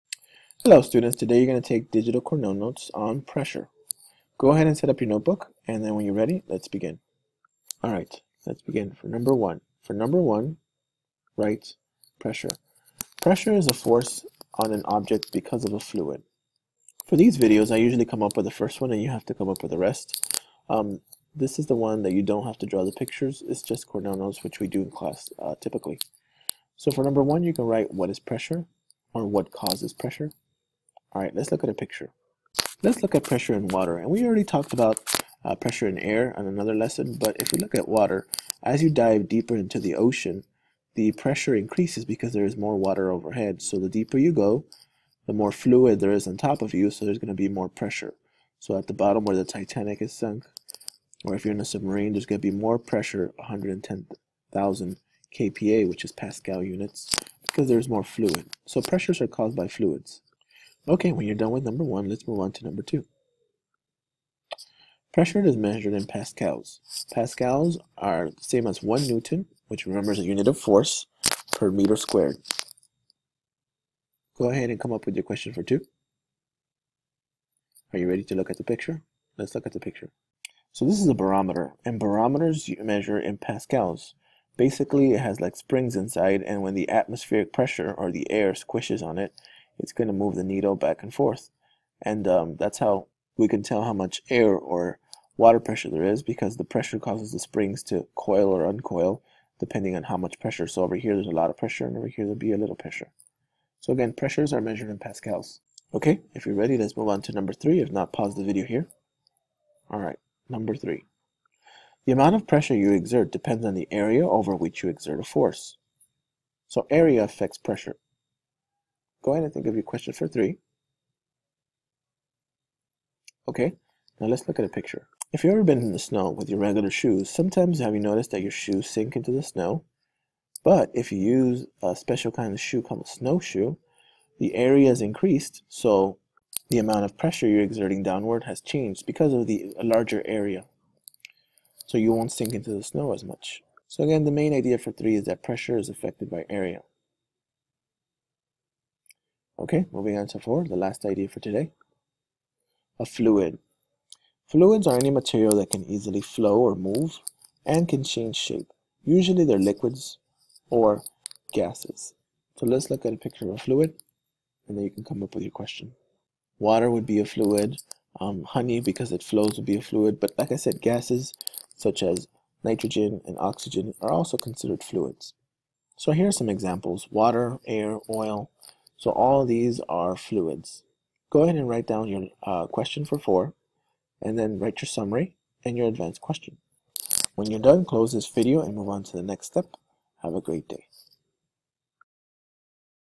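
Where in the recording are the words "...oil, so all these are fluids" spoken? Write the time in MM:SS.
02:58.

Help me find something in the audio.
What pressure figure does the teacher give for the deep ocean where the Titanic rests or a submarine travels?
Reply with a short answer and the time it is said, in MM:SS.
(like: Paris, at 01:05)
110,000 kPa, at 00:53.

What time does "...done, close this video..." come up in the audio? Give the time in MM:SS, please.
03:07.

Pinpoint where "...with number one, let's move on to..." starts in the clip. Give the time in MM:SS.
01:01.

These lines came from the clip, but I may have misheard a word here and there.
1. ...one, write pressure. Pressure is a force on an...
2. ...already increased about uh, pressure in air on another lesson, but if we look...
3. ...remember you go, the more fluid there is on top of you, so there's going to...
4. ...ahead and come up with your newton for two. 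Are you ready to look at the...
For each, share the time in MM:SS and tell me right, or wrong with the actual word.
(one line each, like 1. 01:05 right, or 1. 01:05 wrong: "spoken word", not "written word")
1. 00:10 right
2. 00:34 wrong: "talked", not "increased"
3. 00:43 wrong: "deeper", not "remember"
4. 01:14 wrong: "question", not "newton".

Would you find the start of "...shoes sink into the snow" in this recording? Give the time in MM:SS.
02:08.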